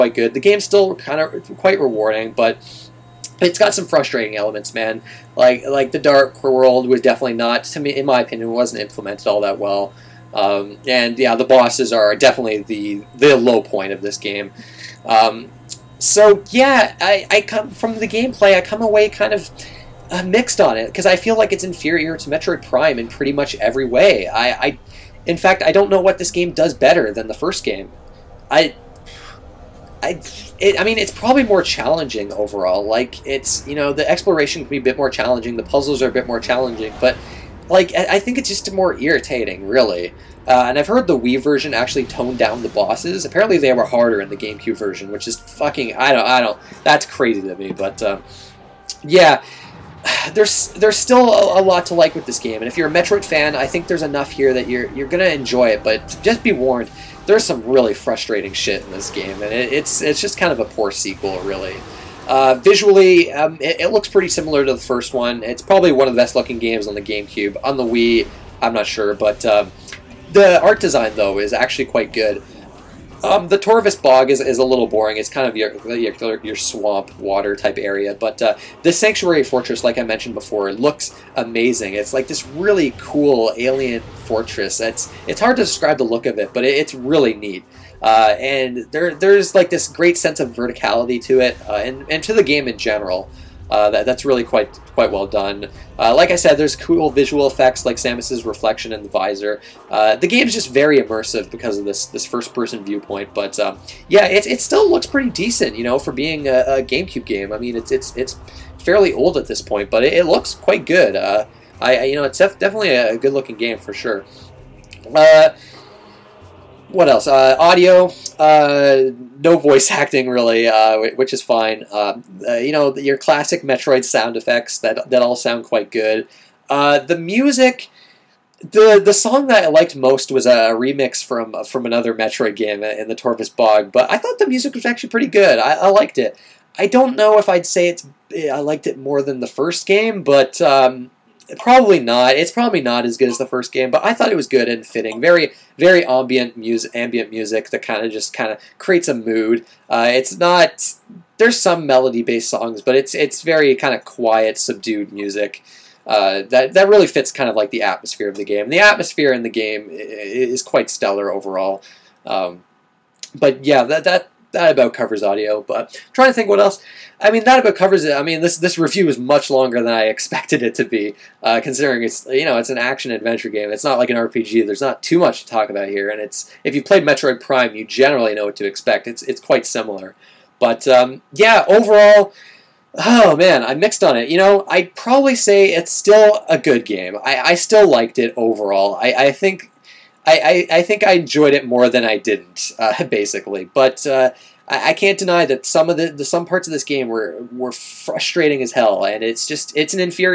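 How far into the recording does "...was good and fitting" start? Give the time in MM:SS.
02:24.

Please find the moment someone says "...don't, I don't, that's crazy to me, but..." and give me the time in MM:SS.
00:46.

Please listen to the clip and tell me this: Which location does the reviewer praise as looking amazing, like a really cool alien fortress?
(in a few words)
Sanctuary Fortress.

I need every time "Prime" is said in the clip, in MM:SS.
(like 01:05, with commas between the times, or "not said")
00:22, 02:57.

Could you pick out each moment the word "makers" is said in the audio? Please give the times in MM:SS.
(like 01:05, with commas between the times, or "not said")
not said.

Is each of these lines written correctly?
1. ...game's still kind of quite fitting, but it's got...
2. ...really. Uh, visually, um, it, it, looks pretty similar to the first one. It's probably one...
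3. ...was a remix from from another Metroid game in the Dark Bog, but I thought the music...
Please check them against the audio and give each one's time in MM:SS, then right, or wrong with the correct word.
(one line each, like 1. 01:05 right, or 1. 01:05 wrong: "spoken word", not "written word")
1. 00:00 wrong: "rewarding", not "fitting"
2. 01:01 right
3. 02:10 wrong: "Torvus", not "Dark".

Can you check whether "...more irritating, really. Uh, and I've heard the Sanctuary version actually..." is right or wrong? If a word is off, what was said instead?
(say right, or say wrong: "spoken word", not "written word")
wrong: "Wii", not "Sanctuary".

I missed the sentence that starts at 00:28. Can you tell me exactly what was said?
I I, it, I mean, it's probably more challenging overall.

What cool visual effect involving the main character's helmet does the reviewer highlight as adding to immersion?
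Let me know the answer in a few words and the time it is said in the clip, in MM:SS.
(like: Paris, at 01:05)
Samus's reflection in the visor, at 01:37.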